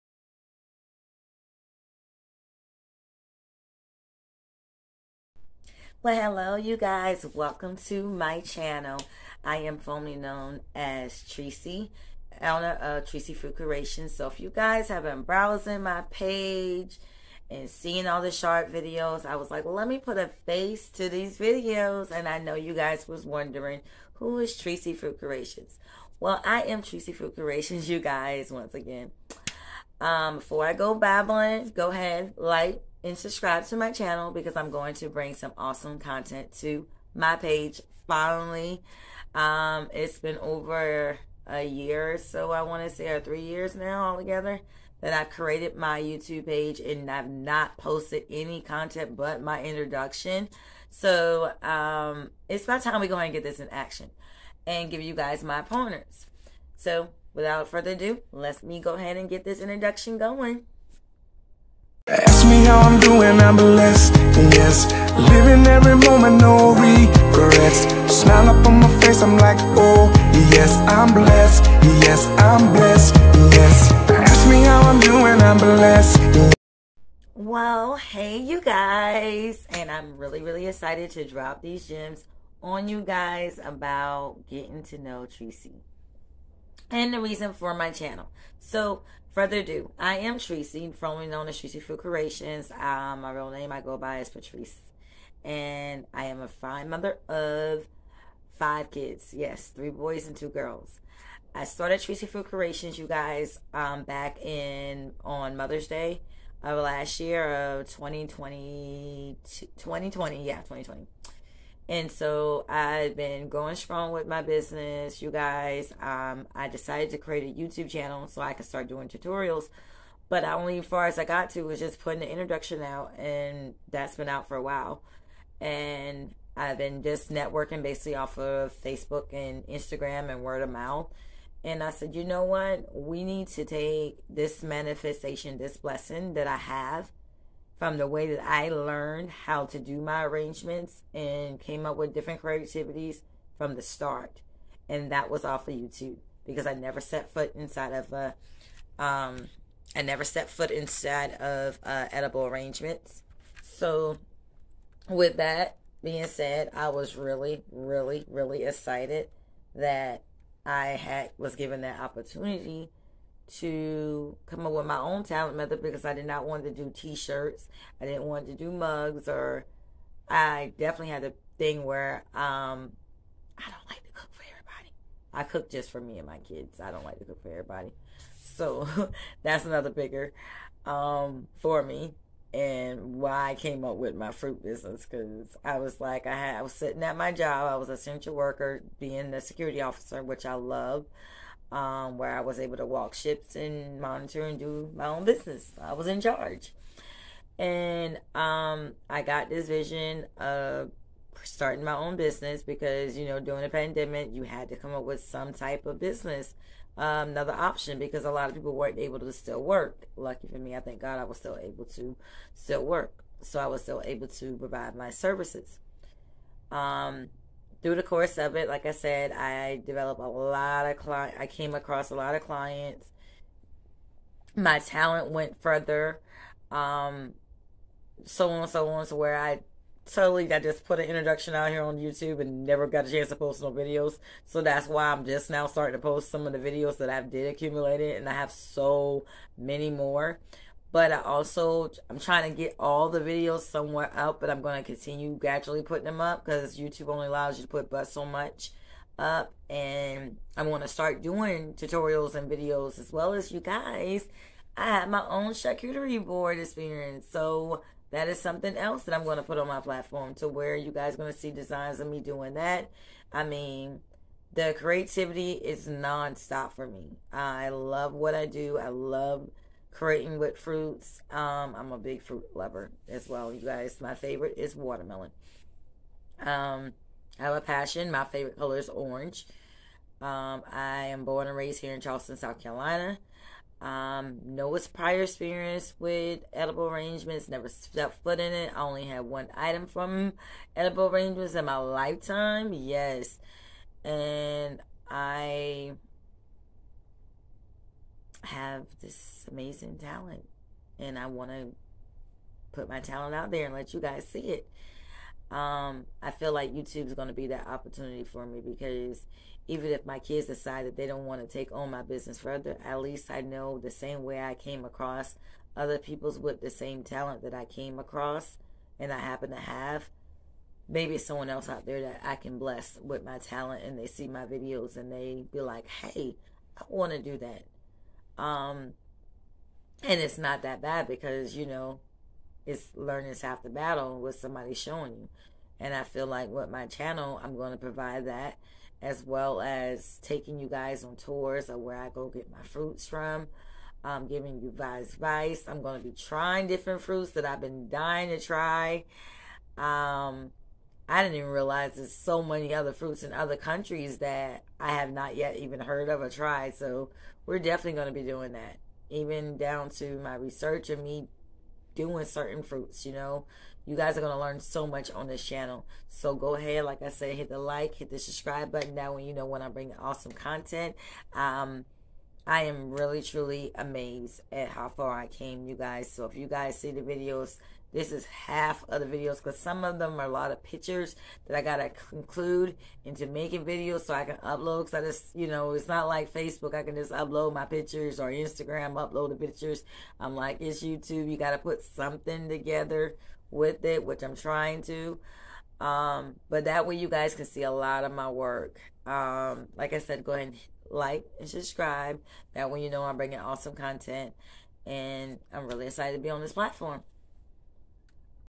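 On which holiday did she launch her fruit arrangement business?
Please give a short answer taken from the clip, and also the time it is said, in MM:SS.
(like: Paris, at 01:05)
Mother's Day, at 01:45.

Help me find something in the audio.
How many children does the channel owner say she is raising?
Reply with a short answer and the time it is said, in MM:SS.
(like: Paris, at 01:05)
5, at 01:38.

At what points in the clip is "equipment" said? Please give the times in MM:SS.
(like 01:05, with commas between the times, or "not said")
not said.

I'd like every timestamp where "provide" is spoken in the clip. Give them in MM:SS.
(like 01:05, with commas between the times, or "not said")
03:34, 05:37.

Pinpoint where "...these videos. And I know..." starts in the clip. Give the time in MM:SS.
00:21.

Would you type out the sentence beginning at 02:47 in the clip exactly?
I didn't want to do mugs, or I definitely had a thing where um, I don't like to cook for everybody.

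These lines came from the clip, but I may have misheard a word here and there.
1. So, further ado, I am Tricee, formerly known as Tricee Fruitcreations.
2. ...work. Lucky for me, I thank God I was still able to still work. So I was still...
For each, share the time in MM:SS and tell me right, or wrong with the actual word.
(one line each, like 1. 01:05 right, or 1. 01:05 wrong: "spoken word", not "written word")
1. 01:28 right
2. 03:29 right.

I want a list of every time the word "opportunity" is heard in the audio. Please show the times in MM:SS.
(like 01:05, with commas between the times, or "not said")
02:41, 05:07.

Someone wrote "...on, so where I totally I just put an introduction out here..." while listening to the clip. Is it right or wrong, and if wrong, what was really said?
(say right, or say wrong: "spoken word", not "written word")
right.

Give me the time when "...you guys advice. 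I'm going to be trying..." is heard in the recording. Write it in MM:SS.
05:44.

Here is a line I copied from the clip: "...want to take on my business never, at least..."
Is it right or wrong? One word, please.
wrong.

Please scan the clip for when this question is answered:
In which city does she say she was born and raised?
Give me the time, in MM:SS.
04:42.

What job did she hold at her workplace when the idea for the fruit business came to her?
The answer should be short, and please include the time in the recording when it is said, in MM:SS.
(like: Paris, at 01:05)
Security officer, at 03:09.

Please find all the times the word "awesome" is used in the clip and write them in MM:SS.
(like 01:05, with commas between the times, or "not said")
00:35, 06:09, 06:43.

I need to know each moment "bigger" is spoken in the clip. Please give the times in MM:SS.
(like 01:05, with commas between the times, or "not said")
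02:59.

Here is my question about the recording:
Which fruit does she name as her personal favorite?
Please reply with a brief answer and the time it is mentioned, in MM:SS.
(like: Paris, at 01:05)
Watermelon, at 04:34.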